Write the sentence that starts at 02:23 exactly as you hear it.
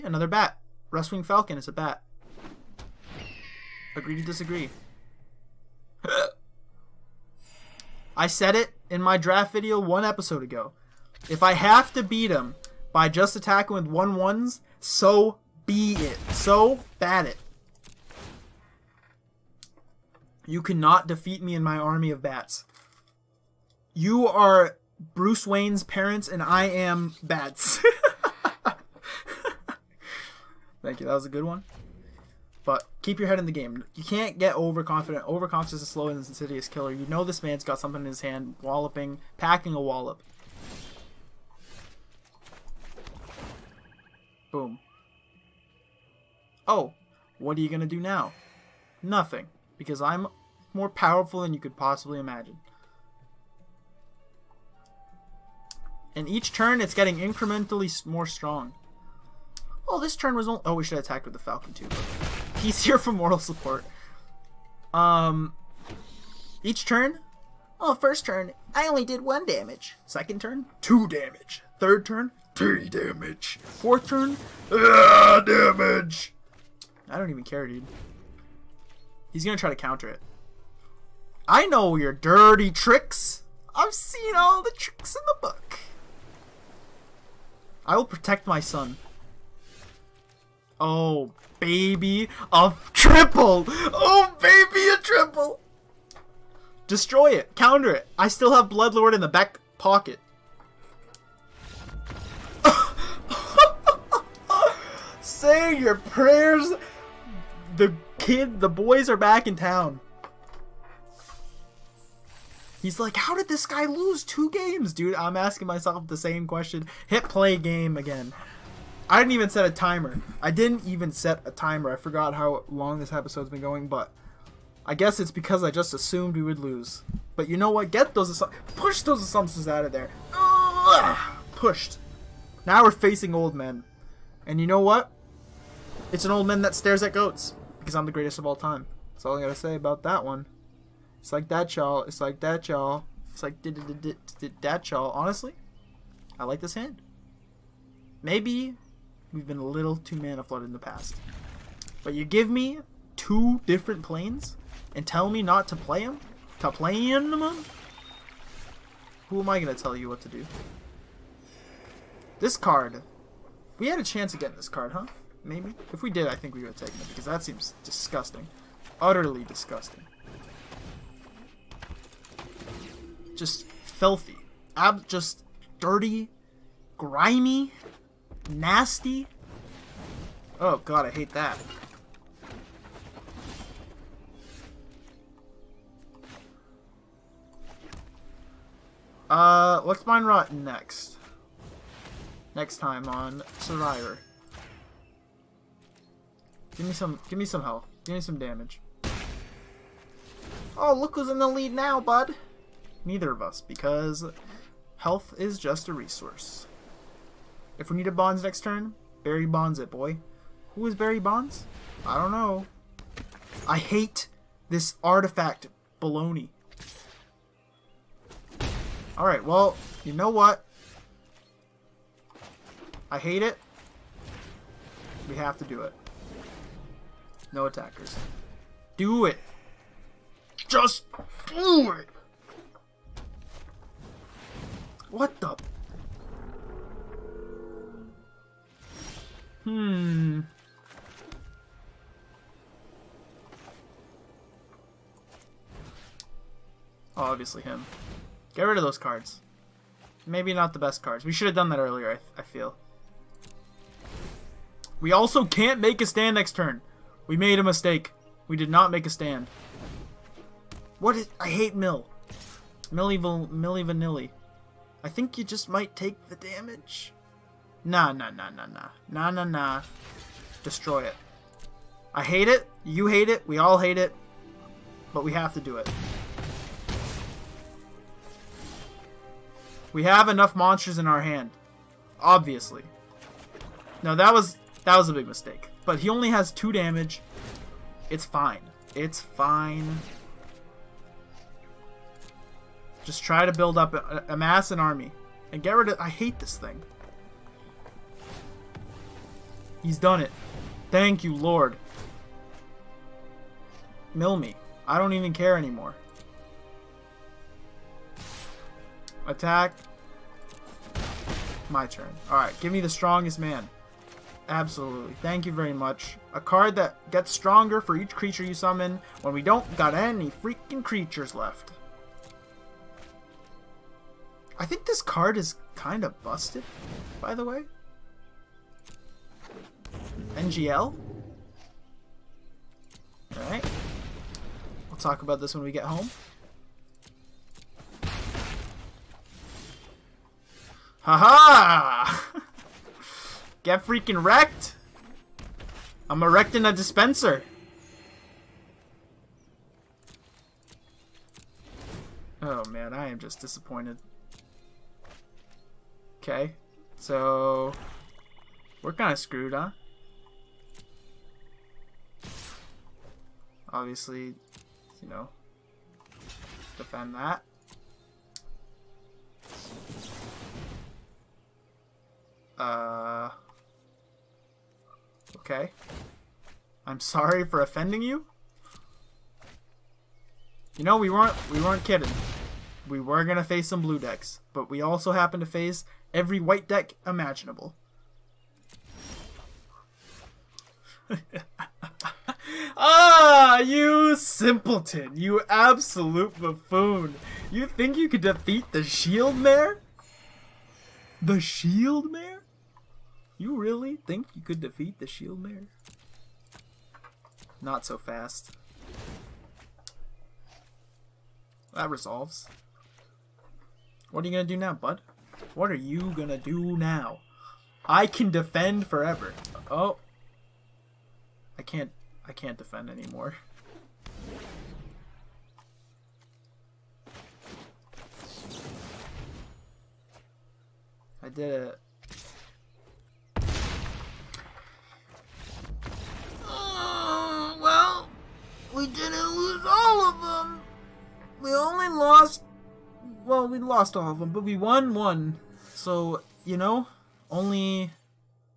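It's like did did did that, y'all.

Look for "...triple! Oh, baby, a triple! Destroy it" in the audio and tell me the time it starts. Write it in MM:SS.
01:32.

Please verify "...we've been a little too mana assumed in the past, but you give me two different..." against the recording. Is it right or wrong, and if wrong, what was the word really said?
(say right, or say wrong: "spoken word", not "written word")
wrong: "flooded", not "assumed".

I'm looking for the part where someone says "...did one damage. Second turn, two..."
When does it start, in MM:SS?
01:09.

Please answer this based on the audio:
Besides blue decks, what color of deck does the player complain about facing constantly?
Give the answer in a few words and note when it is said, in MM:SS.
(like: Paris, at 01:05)
white, at 06:26.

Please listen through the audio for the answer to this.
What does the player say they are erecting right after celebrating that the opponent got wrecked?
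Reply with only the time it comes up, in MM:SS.
05:46.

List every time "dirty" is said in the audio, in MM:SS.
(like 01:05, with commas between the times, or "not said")
01:22, 02:55.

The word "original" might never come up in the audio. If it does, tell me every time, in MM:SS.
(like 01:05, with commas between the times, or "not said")
not said.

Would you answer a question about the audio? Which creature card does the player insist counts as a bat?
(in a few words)
Rustwing Falcon.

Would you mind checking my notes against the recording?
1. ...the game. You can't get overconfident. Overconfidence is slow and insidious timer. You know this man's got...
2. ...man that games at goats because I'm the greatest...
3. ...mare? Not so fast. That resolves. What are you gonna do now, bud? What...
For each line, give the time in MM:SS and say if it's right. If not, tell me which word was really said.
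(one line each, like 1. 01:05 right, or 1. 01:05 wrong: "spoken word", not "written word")
1. 00:33 wrong: "killer", not "timer"
2. 02:16 wrong: "stares", not "games"
3. 06:45 right.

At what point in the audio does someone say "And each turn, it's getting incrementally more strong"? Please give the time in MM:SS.
00:56.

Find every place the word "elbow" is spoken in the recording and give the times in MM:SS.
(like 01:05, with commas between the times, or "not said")
not said.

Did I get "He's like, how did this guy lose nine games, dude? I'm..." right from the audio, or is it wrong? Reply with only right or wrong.
wrong.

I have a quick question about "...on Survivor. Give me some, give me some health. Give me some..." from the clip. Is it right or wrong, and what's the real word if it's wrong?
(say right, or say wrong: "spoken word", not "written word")
right.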